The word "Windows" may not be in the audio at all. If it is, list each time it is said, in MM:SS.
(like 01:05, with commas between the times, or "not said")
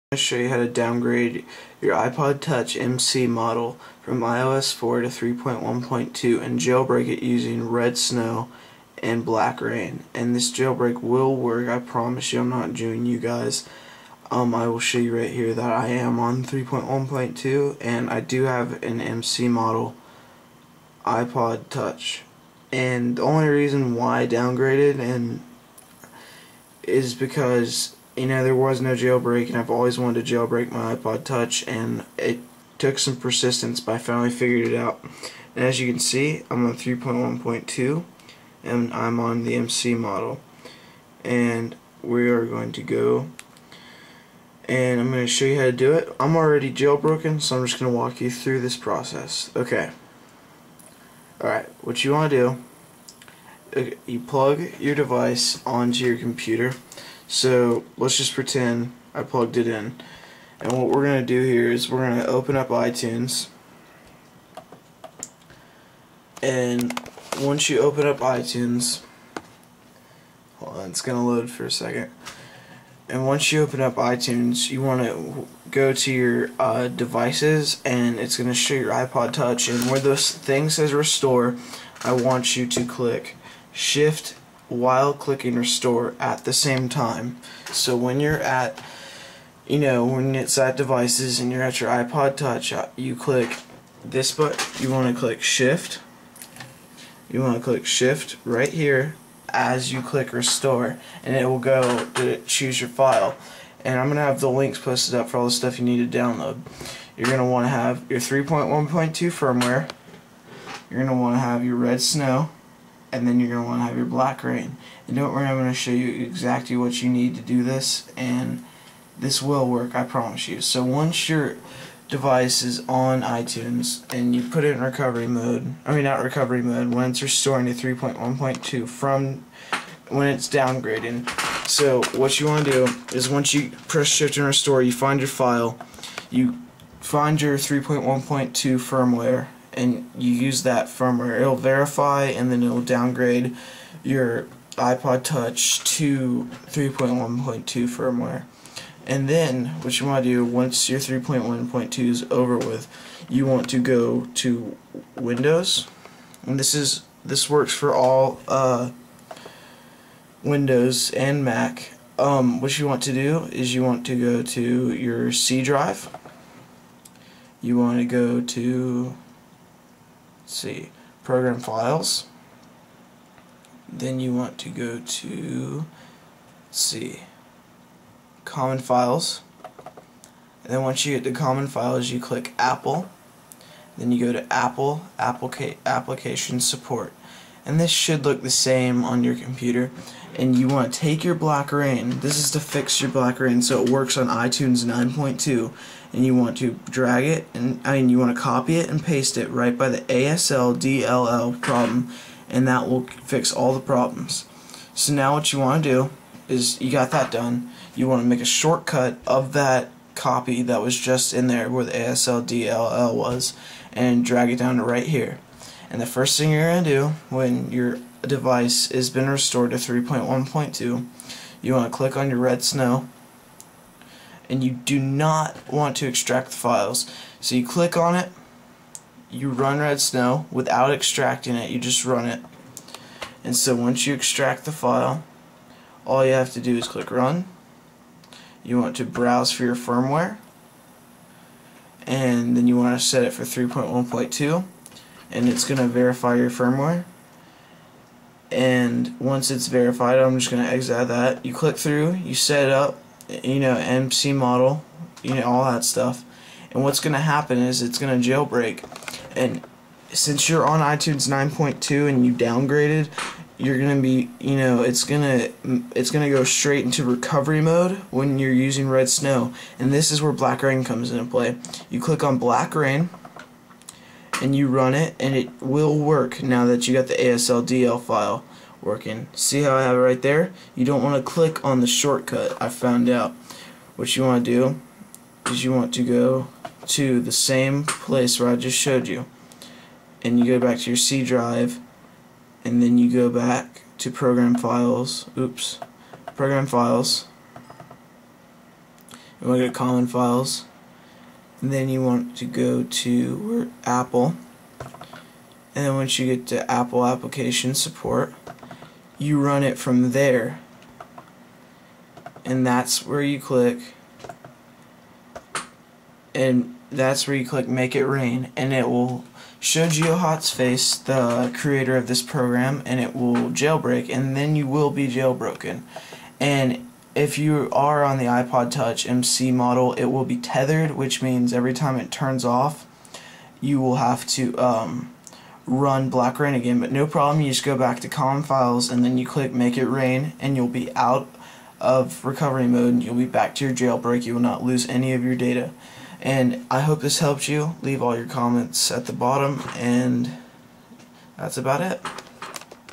02:35, 02:40.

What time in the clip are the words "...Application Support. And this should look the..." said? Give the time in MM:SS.
03:05.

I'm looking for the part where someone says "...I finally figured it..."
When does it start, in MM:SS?
00:33.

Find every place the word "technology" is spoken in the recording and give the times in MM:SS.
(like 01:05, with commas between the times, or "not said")
not said.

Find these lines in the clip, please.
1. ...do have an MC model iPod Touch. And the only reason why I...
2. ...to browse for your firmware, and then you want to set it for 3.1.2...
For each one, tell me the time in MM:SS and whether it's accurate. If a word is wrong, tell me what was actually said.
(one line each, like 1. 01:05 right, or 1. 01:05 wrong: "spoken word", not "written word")
1. 00:18 right
2. 03:58 right.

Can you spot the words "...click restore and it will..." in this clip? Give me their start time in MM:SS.
01:40.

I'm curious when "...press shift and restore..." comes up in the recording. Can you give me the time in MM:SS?
02:13.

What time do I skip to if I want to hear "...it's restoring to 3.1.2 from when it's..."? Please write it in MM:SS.
02:07.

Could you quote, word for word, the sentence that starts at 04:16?
And what's going to happen is it's going to jailbreak.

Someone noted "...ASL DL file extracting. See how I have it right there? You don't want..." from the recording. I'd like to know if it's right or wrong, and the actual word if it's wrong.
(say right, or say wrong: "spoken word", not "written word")
wrong: "working", not "extracting".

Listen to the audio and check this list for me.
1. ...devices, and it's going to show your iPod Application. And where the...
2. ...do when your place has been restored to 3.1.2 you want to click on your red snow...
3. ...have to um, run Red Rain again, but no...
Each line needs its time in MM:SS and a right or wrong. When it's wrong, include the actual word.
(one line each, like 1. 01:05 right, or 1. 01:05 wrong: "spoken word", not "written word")
1. 01:16 wrong: "Touch", not "Application"
2. 03:36 wrong: "device", not "place"
3. 05:33 wrong: "Black", not "Red".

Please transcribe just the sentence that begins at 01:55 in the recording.
And don't worry, I'm going to show you exactly what you need to do this, and this will work, I promise you.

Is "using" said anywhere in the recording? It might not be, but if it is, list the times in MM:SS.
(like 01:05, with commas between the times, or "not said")
00:07, 04:28.